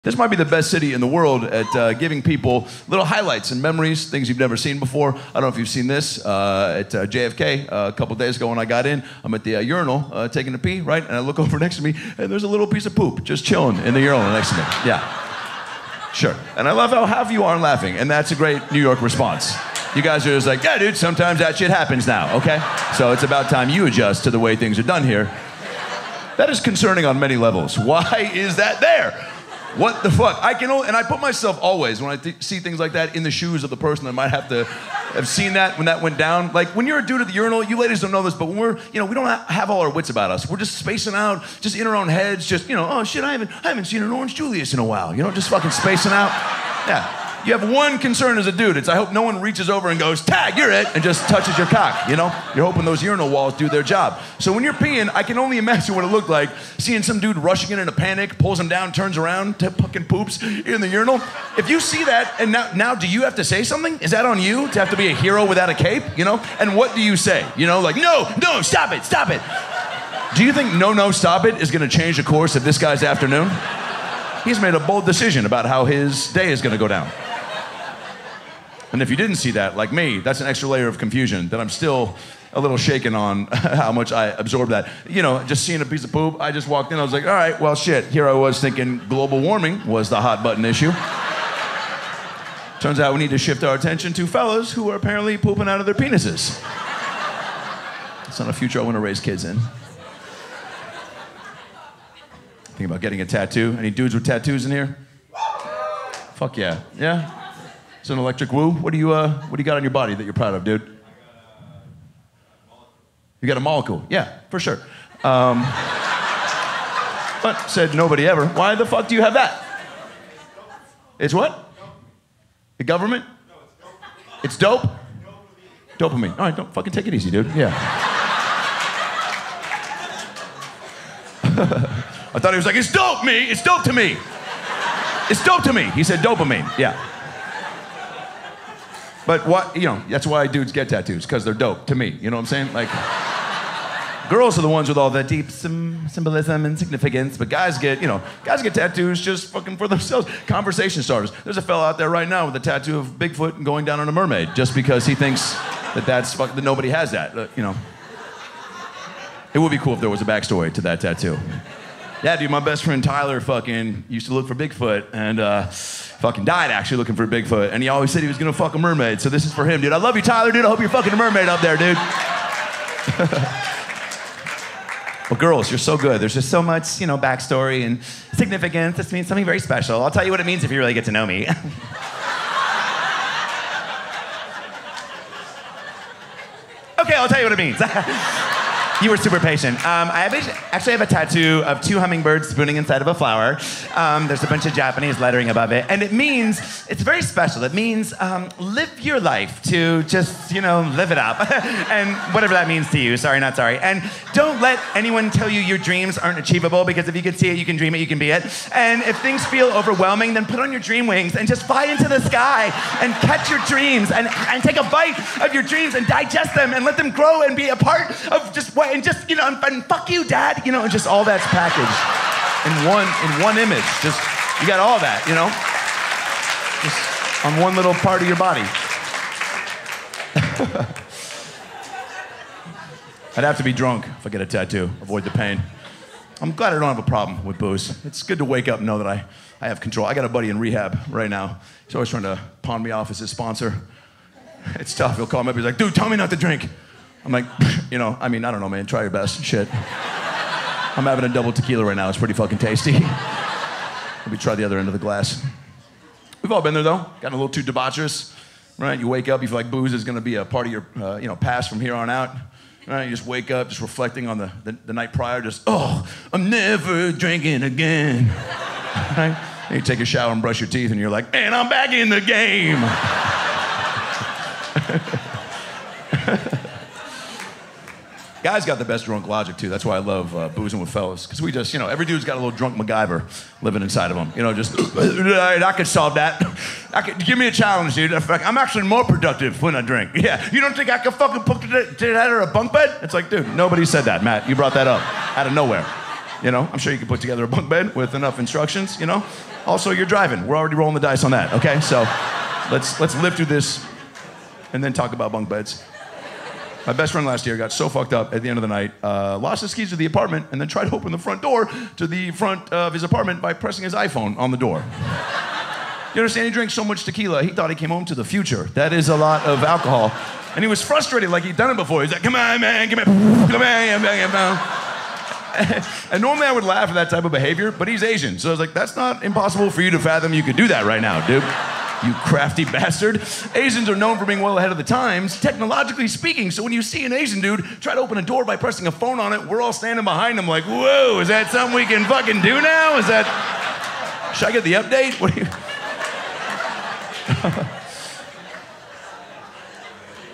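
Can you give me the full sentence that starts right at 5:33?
Asians are known for being well ahead of the times, technologically speaking.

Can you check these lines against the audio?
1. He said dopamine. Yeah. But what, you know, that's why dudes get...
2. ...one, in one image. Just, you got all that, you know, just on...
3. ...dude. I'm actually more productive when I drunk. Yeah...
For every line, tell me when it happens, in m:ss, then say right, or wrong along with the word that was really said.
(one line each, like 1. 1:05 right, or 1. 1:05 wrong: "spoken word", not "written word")
1. 2:15 right
2. 3:42 right
3. 4:47 wrong: "drink", not "drunk".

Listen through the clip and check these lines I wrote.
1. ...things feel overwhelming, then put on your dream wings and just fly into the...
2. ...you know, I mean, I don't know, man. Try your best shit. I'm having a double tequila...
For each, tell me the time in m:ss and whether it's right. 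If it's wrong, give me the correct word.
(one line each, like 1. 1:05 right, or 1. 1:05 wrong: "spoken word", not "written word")
1. 3:29 right
2. 4:07 right.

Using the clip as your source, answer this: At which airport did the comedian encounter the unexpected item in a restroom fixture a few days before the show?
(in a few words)
JFK.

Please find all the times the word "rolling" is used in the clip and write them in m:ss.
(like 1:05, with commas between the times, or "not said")
5:00.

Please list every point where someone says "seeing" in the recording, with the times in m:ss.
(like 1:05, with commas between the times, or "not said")
0:56, 1:25.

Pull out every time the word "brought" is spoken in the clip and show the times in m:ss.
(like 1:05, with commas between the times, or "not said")
4:54.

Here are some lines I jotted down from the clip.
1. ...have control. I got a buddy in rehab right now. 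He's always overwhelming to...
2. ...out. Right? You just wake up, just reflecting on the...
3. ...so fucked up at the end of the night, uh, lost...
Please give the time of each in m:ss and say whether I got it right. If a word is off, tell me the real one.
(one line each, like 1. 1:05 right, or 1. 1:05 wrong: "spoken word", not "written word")
1. 3:59 wrong: "trying", not "overwhelming"
2. 4:22 right
3. 5:07 right.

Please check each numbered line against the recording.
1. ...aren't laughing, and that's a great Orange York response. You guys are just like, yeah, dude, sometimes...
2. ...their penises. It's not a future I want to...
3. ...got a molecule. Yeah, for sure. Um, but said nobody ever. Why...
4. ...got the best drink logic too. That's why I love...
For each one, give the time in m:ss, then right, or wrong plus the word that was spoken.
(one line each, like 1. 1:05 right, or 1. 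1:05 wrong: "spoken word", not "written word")
1. 0:17 wrong: "New", not "Orange"
2. 1:35 right
3. 1:53 right
4. 4:38 wrong: "drunk", not "drink".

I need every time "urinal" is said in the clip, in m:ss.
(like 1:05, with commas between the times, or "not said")
0:09, 0:14, 0:37, 0:53, 1:00.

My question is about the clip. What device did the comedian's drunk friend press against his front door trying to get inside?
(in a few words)
iPhone.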